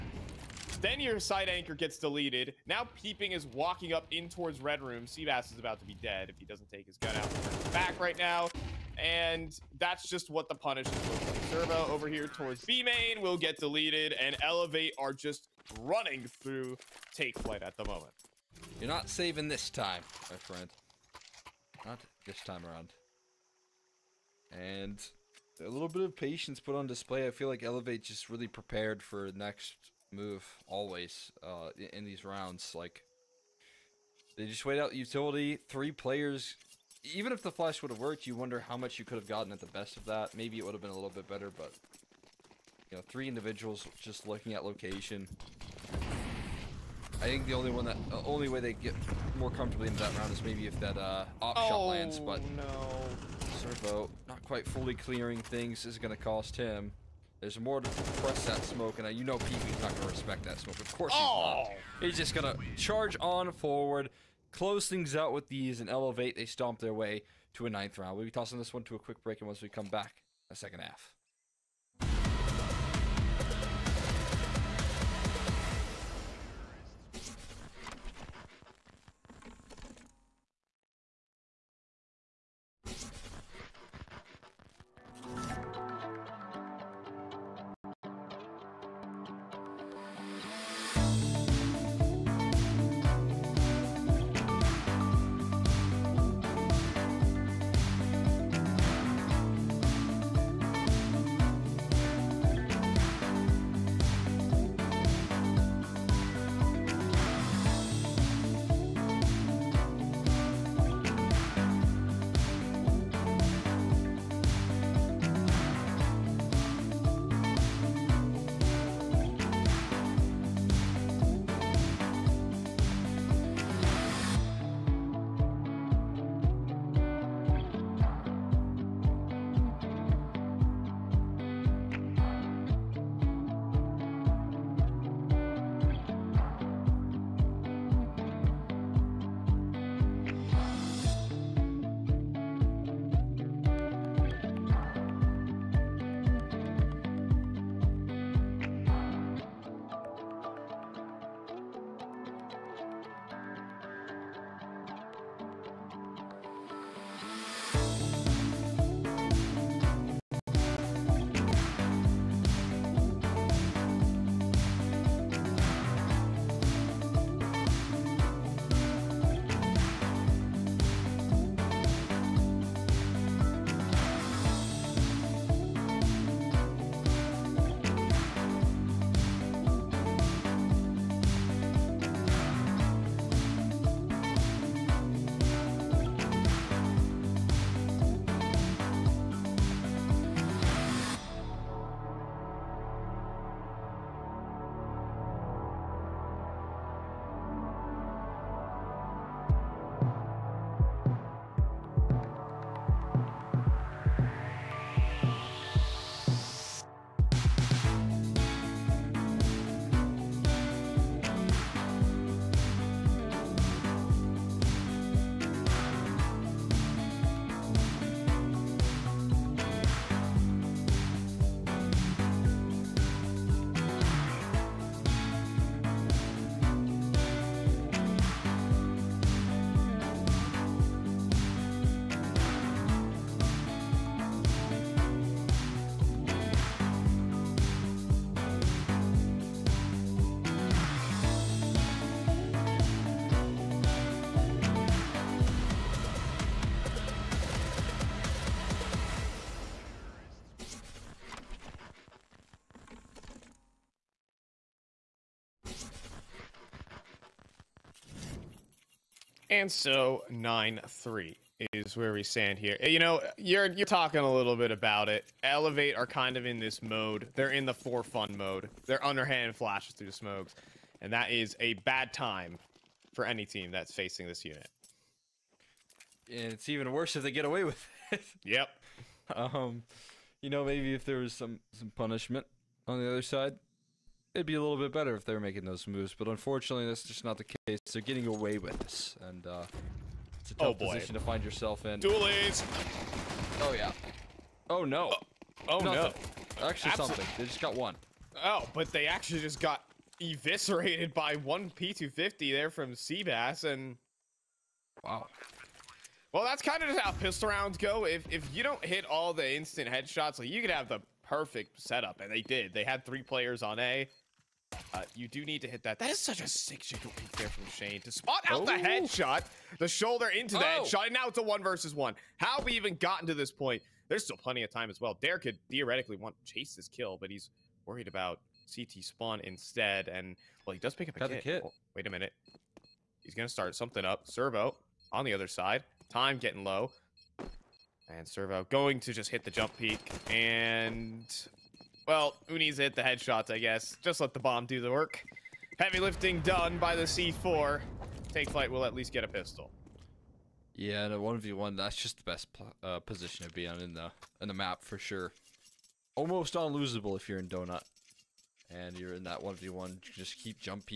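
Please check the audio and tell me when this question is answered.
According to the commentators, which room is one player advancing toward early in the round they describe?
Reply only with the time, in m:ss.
0:04.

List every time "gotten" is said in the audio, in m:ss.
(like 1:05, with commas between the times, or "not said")
0:39, 5:22.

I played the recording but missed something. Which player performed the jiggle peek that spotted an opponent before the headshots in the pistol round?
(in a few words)
Shane.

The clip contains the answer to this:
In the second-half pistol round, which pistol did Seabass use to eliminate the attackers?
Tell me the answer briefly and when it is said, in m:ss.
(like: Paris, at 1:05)
P250, at 5:01.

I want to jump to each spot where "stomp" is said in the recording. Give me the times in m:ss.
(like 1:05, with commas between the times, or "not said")
1:06.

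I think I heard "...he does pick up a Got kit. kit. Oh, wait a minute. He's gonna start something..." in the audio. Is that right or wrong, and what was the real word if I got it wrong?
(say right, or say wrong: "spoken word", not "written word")
right.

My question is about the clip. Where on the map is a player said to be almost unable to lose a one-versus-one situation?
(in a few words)
Donut.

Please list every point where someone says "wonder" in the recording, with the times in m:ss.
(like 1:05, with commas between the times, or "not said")
0:38.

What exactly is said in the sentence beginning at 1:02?
He's just going to charge on forward, close things out with these, and elevate.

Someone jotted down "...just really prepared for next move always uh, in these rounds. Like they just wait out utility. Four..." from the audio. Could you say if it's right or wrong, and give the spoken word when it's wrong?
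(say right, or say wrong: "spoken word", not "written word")
wrong: "Three", not "Four".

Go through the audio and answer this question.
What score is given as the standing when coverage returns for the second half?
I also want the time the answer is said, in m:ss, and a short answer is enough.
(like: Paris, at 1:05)
9-3, at 4:20.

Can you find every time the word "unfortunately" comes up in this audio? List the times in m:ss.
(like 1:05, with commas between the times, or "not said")
4:46.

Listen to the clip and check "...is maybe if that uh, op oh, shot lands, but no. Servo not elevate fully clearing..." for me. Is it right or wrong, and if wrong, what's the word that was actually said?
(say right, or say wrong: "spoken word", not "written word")
wrong: "quite", not "elevate".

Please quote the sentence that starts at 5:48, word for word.
Take Flyte, we'll at least get a pistol.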